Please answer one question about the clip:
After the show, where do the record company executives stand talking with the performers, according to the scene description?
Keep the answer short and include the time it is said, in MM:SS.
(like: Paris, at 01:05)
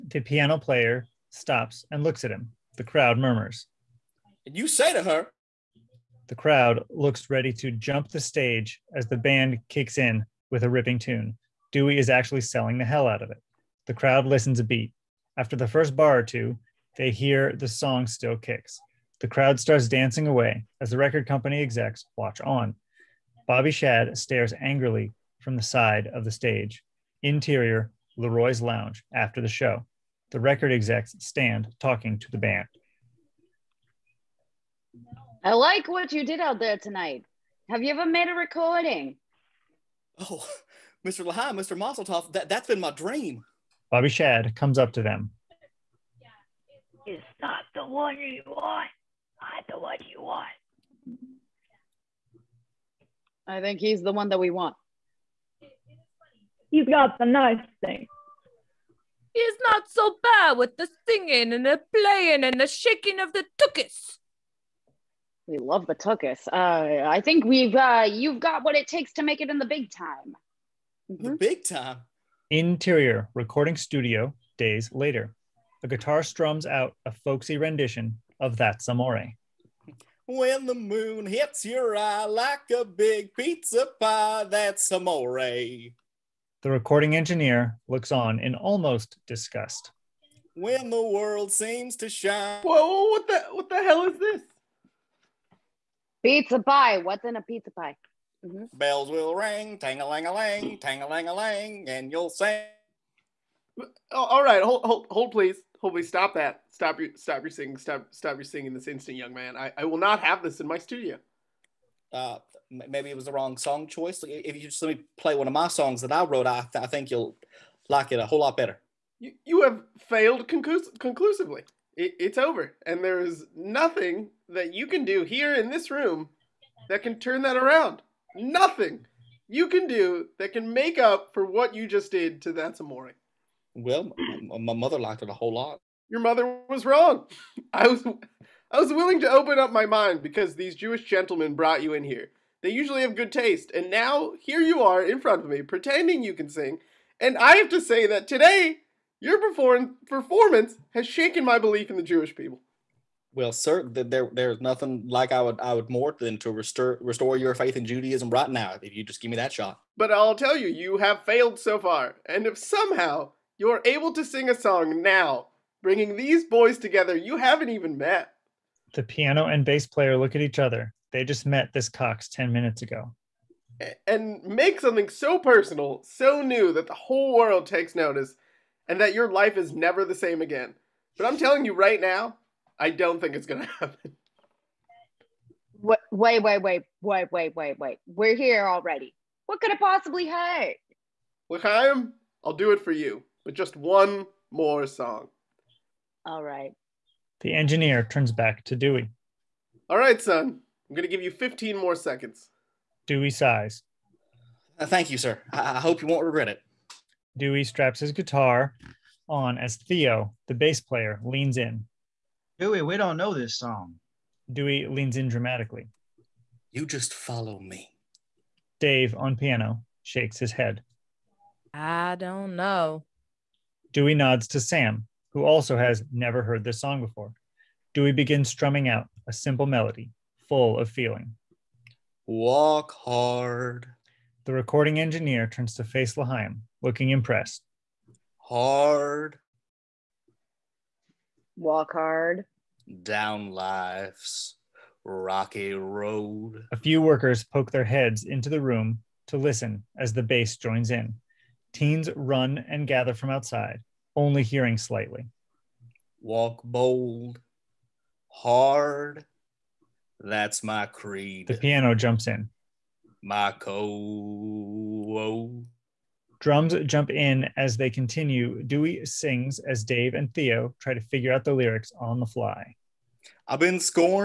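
Leroy's lounge, at 00:28.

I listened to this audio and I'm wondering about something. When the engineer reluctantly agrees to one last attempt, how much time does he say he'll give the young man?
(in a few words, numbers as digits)
15 seconds.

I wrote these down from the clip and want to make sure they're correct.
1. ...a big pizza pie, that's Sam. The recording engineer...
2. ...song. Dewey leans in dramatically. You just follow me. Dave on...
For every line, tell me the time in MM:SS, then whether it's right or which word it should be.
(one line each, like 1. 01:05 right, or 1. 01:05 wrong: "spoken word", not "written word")
1. 01:22 wrong: "Amore", not "Sam"
2. 03:33 right.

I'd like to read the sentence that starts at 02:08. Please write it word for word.
Nothing you can do that can make up for what you just did to That's Amore.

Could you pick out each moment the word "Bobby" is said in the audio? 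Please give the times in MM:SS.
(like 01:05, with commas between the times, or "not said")
00:23, 00:43.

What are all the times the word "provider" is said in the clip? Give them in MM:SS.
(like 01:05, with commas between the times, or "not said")
not said.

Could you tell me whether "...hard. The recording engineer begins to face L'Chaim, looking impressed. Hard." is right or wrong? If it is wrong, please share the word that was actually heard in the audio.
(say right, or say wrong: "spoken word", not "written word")
wrong: "turns", not "begins".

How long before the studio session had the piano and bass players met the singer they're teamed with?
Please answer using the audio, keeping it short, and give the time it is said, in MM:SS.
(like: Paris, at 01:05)
10 minutes, at 02:52.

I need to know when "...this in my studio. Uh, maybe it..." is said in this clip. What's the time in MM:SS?
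01:50.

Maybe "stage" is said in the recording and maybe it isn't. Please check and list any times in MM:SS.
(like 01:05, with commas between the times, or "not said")
00:08, 00:26.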